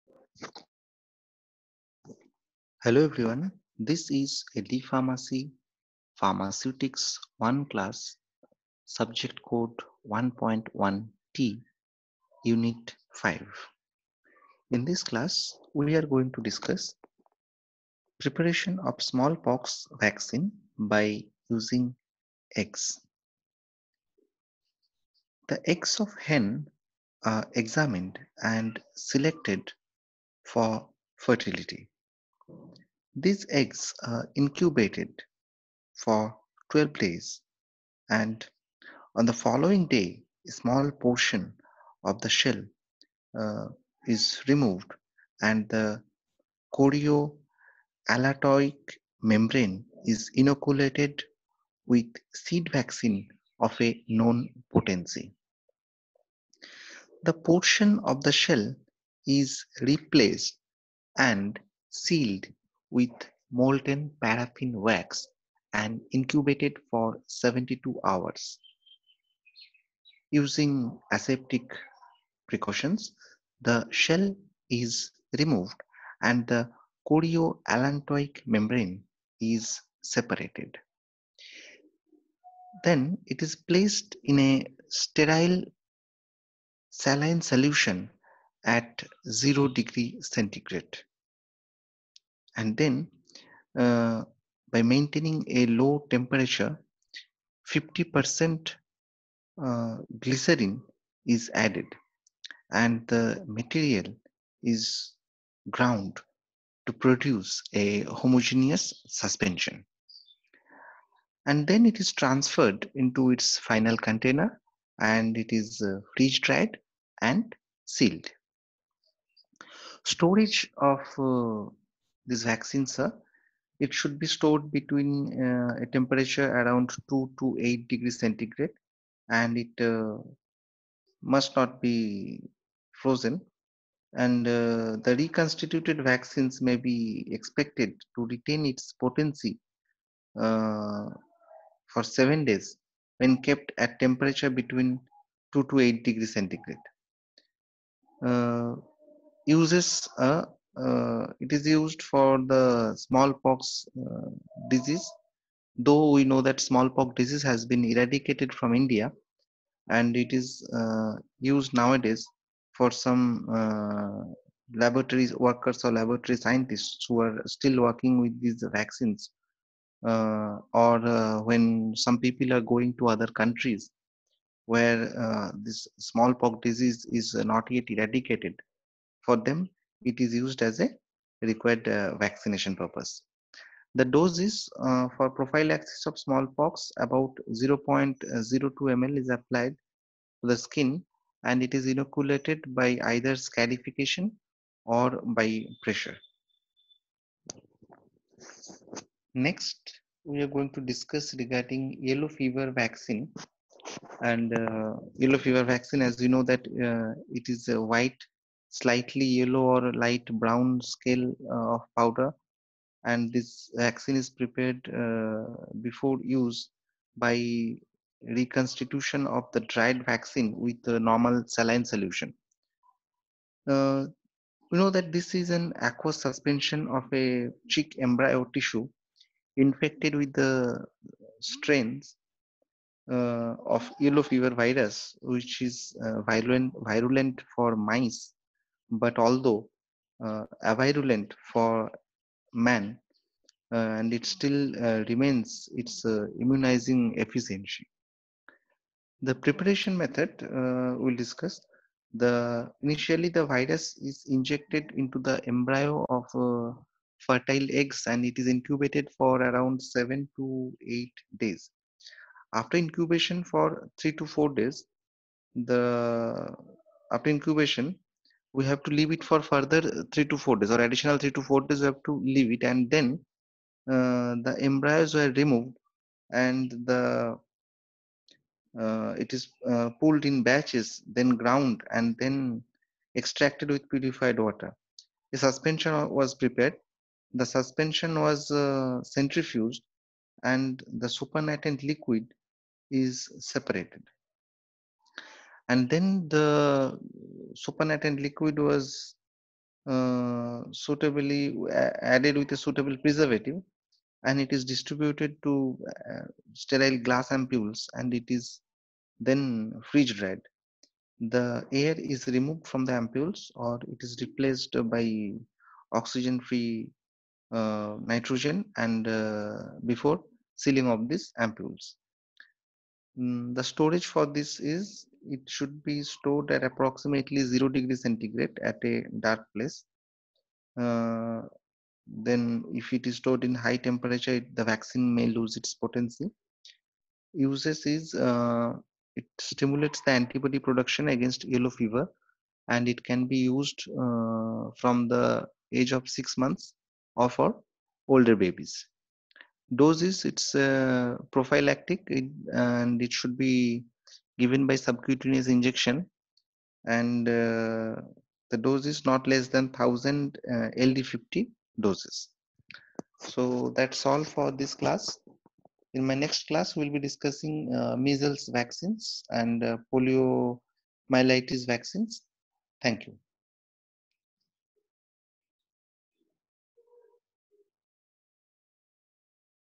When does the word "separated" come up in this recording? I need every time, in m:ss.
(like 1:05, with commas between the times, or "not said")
1:20, 4:53.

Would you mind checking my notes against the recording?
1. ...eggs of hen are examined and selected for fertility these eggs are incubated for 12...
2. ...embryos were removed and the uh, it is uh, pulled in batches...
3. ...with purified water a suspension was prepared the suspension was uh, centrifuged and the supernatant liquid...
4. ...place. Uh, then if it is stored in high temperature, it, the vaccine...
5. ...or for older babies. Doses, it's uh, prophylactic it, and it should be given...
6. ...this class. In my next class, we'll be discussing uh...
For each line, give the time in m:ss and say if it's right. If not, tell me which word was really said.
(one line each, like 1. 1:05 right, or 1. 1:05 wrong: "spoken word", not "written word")
1. 0:25 right
2. 4:34 right
3. 4:43 right
4. 5:29 right
5. 5:47 right
6. 6:04 right.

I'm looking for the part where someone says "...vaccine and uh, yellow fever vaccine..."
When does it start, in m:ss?
3:22.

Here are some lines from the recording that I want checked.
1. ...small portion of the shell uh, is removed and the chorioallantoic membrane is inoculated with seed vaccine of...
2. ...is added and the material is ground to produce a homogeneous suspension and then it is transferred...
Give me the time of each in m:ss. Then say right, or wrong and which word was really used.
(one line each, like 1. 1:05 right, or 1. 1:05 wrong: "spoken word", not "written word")
1. 0:40 right
2. 1:41 right.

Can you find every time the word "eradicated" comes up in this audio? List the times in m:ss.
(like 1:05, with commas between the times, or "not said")
2:37, 2:57.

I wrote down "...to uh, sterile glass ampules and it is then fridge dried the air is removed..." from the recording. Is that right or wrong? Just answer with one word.
right.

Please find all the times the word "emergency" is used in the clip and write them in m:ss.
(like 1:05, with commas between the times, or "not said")
not said.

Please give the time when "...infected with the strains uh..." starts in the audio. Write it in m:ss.
3:49.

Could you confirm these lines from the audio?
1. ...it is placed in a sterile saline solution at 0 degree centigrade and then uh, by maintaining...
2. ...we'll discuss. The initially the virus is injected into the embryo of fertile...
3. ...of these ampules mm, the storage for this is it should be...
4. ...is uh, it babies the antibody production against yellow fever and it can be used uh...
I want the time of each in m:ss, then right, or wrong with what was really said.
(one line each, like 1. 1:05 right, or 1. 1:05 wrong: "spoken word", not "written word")
1. 1:23 right
2. 4:10 right
3. 5:20 right
4. 5:37 wrong: "stimulates", not "babies".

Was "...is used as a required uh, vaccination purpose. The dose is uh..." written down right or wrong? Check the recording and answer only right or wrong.
right.